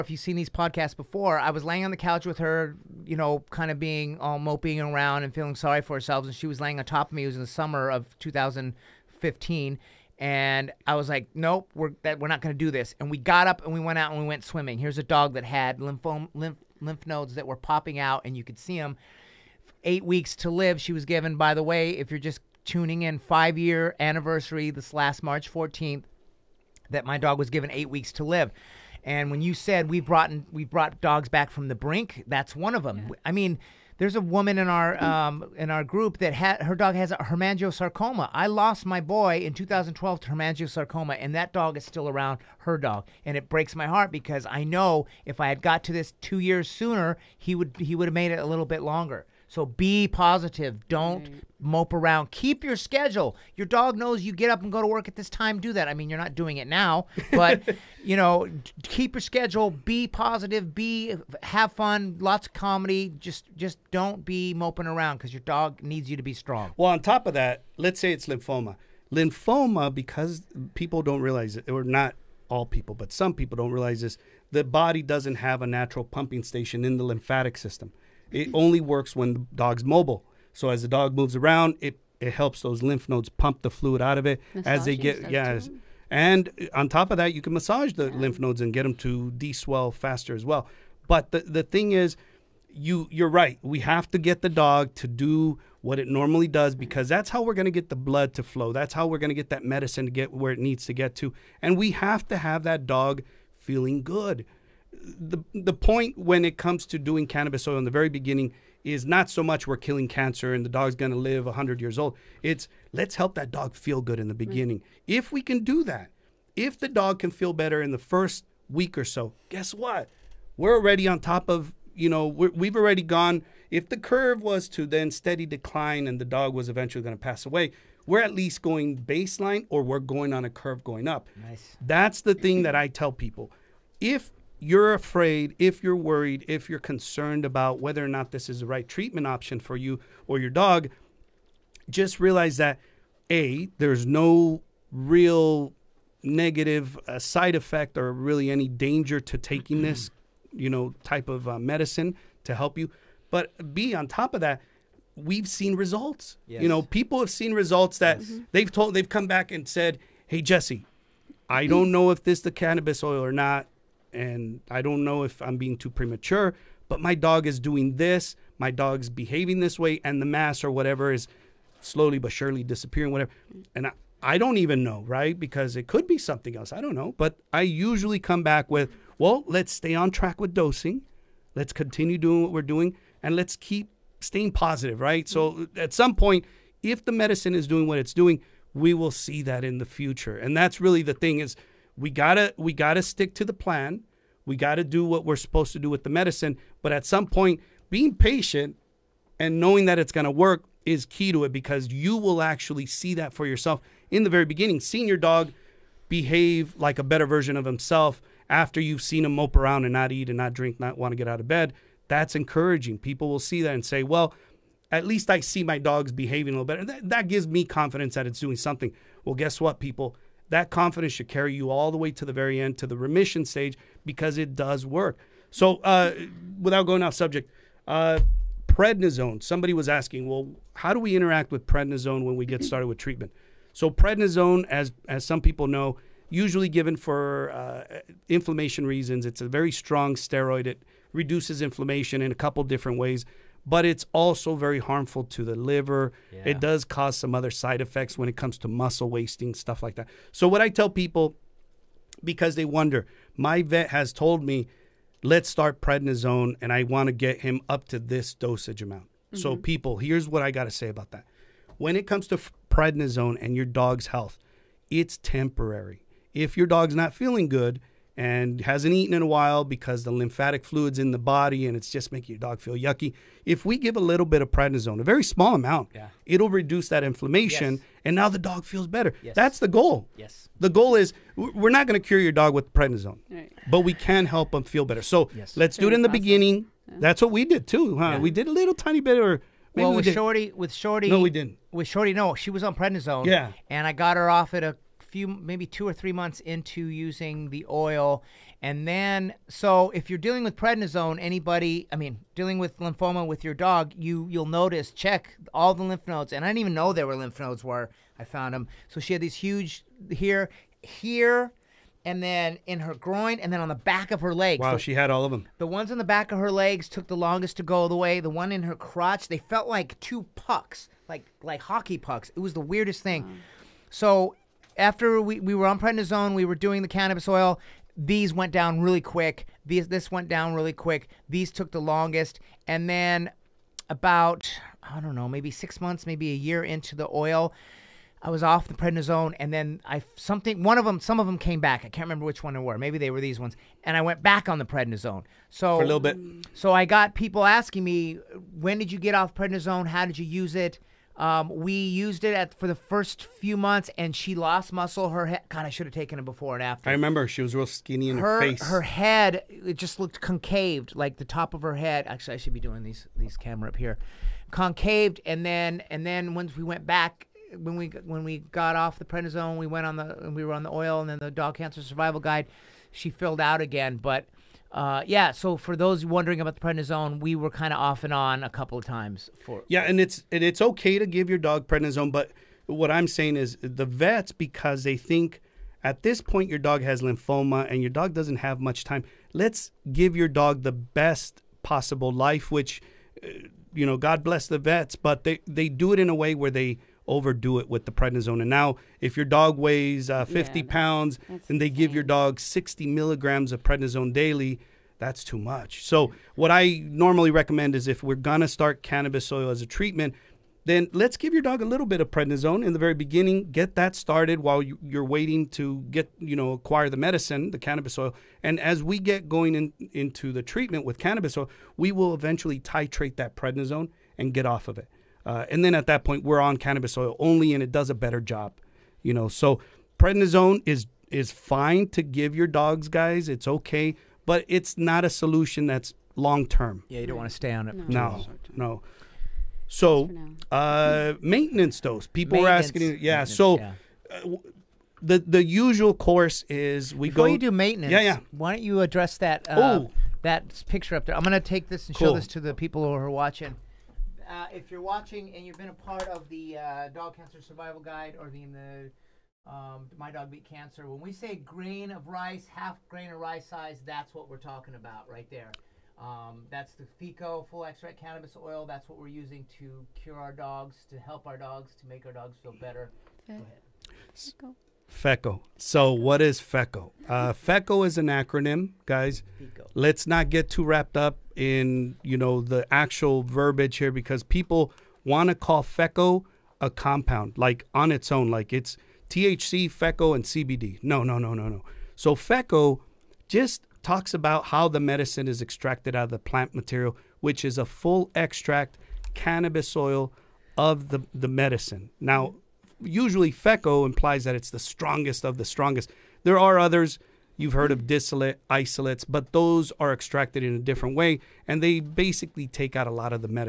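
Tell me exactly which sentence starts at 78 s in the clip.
It only works when the dog's mobile.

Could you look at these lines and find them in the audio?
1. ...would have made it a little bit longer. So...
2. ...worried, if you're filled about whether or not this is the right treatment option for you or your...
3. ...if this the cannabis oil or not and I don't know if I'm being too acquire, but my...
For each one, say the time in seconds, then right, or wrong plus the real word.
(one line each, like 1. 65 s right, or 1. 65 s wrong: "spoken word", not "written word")
1. 47 s right
2. 135 s wrong: "concerned", not "filled"
3. 162 s wrong: "premature", not "acquire".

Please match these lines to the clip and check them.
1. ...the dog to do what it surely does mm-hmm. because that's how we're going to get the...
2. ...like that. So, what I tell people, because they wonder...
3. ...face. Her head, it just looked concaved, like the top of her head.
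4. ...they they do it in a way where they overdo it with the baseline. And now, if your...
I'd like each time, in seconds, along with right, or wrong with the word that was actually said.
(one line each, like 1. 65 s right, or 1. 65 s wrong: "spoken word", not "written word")
1. 94 s wrong: "normally", not "surely"
2. 249 s right
3. 358 s right
4. 395 s wrong: "prednisone", not "baseline".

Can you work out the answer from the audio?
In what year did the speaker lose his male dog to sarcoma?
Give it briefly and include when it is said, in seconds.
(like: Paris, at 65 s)
2012, at 39 s.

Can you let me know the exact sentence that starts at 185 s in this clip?
So at some point, if the medicine is doing what it's doing, we will see that in the future.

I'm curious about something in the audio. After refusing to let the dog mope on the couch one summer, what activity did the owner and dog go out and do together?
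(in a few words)
swimming.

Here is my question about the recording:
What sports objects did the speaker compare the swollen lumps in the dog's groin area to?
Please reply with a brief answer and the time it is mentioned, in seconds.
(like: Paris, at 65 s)
hockey pucks, at 321 s.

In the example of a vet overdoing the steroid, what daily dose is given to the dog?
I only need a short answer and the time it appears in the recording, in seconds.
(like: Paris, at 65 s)
60 milligrams, at 402 s.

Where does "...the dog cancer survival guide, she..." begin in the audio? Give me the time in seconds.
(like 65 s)
371 s.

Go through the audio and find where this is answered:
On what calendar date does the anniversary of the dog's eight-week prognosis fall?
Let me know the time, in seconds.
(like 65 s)
25 s.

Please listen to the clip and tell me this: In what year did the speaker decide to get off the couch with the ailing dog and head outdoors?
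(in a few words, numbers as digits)
2015.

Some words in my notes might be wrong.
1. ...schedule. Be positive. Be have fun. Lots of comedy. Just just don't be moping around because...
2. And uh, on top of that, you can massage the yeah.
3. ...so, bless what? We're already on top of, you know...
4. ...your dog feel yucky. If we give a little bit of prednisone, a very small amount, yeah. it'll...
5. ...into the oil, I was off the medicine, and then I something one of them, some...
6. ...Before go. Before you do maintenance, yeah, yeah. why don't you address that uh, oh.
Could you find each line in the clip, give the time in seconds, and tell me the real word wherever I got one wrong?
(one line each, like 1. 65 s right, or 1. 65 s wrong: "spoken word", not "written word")
1. 59 s right
2. 86 s right
3. 119 s wrong: "guess", not "bless"
4. 272 s right
5. 336 s wrong: "prednisone", not "medicine"
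6. 447 s right.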